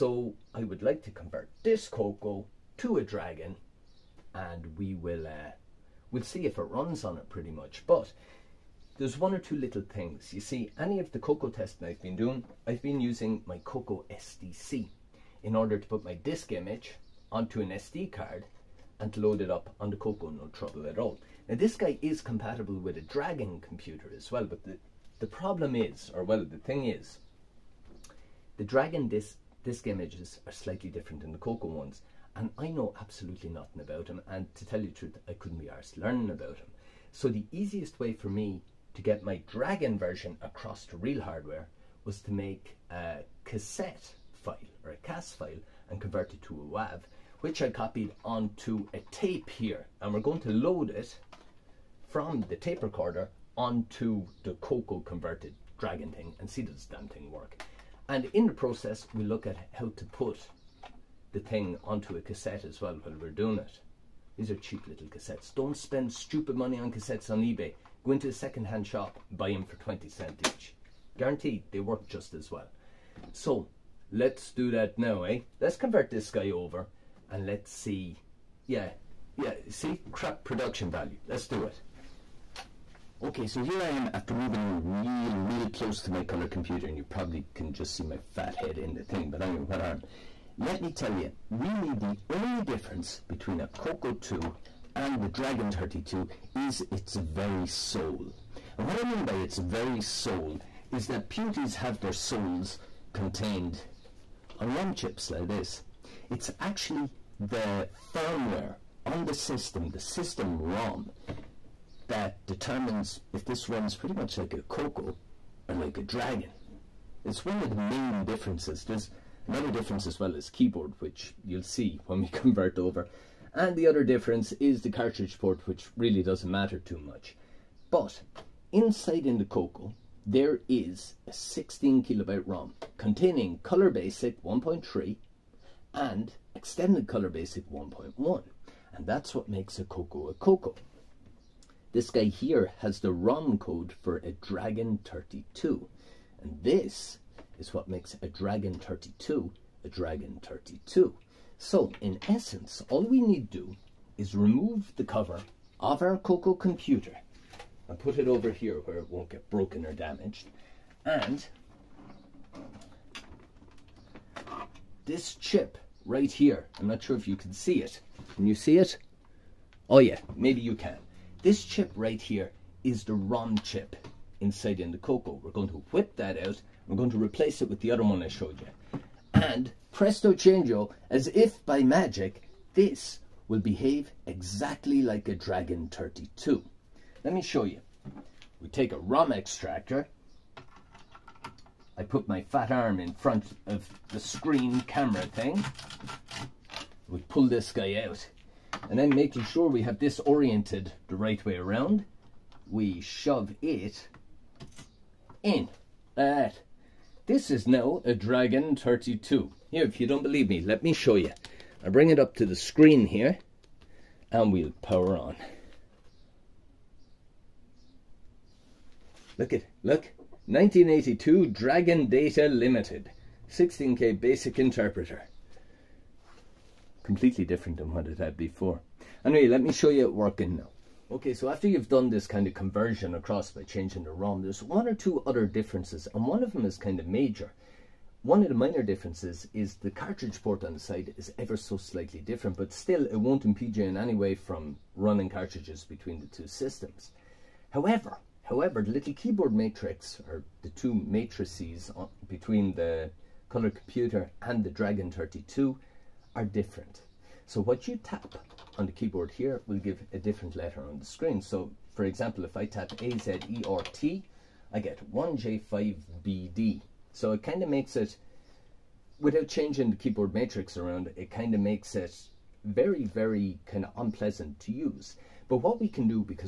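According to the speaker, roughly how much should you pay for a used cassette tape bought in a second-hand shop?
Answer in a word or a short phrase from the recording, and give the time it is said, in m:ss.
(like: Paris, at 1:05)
20 cents, at 1:09.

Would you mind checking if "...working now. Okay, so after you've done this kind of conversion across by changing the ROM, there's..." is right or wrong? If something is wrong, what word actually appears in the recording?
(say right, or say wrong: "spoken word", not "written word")
right.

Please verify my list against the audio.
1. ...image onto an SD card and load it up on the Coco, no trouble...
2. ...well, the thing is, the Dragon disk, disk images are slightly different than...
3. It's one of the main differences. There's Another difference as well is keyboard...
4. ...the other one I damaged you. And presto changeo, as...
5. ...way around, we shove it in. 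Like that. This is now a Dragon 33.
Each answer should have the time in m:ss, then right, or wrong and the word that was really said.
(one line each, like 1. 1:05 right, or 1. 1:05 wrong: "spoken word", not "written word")
1. 0:16 right
2. 0:26 right
3. 1:57 right
4. 2:57 wrong: "showed", not "damaged"
5. 3:21 wrong: "32", not "33".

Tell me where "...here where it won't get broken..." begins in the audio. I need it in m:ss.
2:38.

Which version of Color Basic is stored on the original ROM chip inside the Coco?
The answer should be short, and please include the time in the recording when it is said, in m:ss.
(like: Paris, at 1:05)
1.3, at 2:13.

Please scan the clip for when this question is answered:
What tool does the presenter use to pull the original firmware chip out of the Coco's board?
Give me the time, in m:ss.
3:08.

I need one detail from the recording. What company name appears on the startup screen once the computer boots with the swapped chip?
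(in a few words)
Dragon Data Limited.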